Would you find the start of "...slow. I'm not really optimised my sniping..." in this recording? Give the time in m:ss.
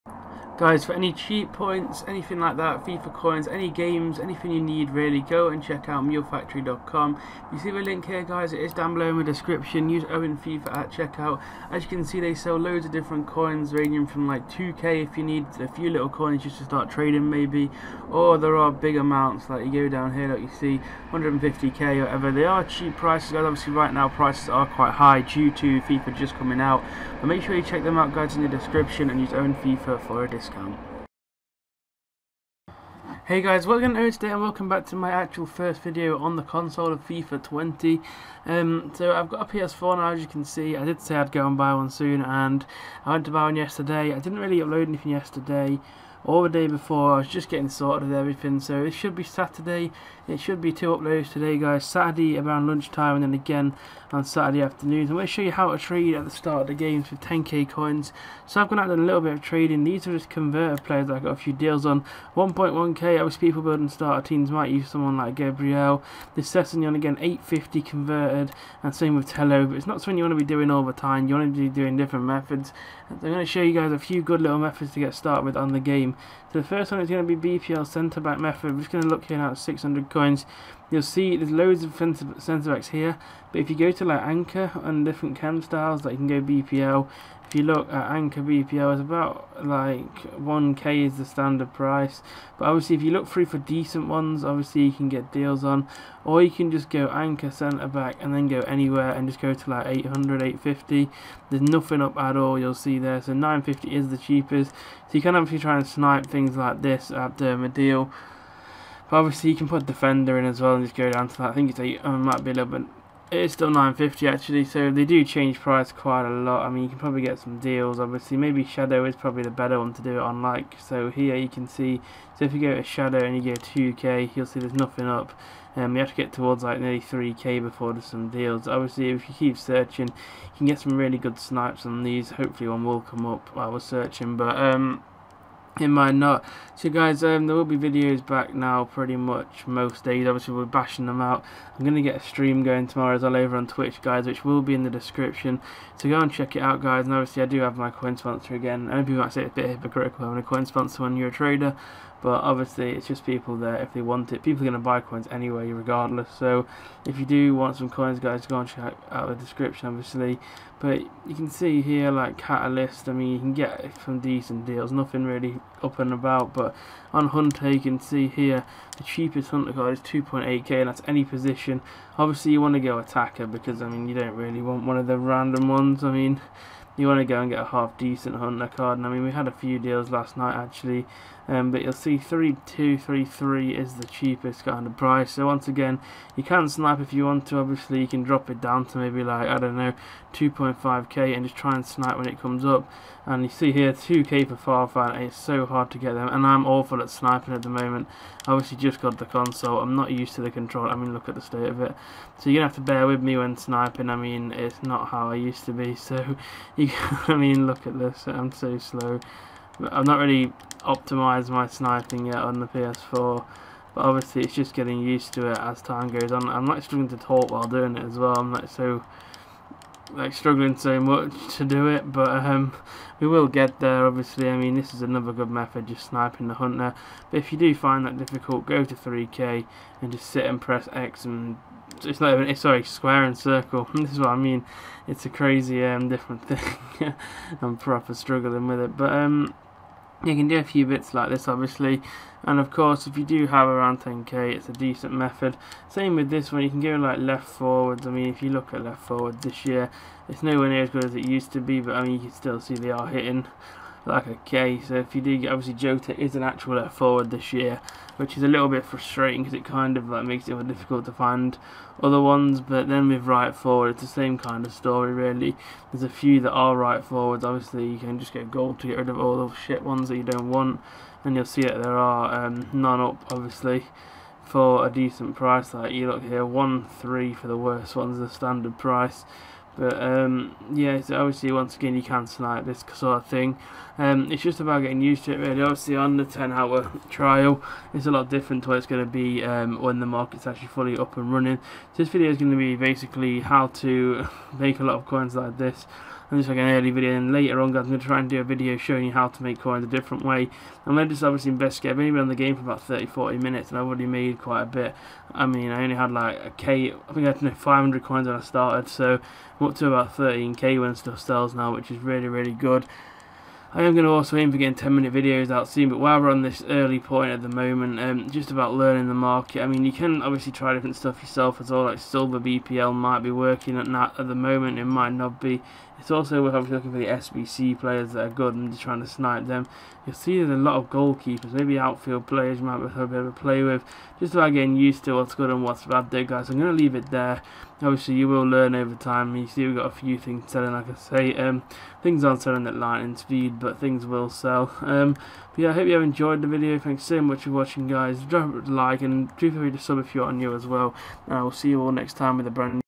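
3:28.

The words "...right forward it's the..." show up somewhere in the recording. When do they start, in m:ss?
4:23.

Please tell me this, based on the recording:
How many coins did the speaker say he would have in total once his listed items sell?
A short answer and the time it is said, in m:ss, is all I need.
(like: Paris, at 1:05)
13k, at 5:10.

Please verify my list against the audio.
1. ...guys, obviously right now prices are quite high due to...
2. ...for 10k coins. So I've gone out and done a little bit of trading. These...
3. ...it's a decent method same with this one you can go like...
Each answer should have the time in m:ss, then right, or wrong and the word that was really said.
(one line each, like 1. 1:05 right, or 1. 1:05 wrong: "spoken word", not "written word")
1. 0:23 right
2. 0:57 right
3. 4:04 right.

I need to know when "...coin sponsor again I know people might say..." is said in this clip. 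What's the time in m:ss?
2:27.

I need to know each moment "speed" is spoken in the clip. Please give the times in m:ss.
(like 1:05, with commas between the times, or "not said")
5:43.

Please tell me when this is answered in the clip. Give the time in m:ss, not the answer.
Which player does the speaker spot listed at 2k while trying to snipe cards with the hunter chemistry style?
3:14.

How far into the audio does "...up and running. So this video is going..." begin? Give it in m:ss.
4:50.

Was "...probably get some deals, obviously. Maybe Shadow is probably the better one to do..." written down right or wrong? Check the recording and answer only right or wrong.
right.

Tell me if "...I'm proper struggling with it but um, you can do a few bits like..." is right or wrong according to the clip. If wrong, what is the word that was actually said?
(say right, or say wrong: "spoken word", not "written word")
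right.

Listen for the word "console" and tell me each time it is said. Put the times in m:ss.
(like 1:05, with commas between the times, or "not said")
0:36, 3:19.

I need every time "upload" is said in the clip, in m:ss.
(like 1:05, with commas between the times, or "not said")
0:44, 0:50.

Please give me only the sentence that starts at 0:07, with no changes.
You see the link here guys, it is down below in the description, use Owen FIFA at checkout.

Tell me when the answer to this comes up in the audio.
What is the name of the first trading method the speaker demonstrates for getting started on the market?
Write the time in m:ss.
1:17.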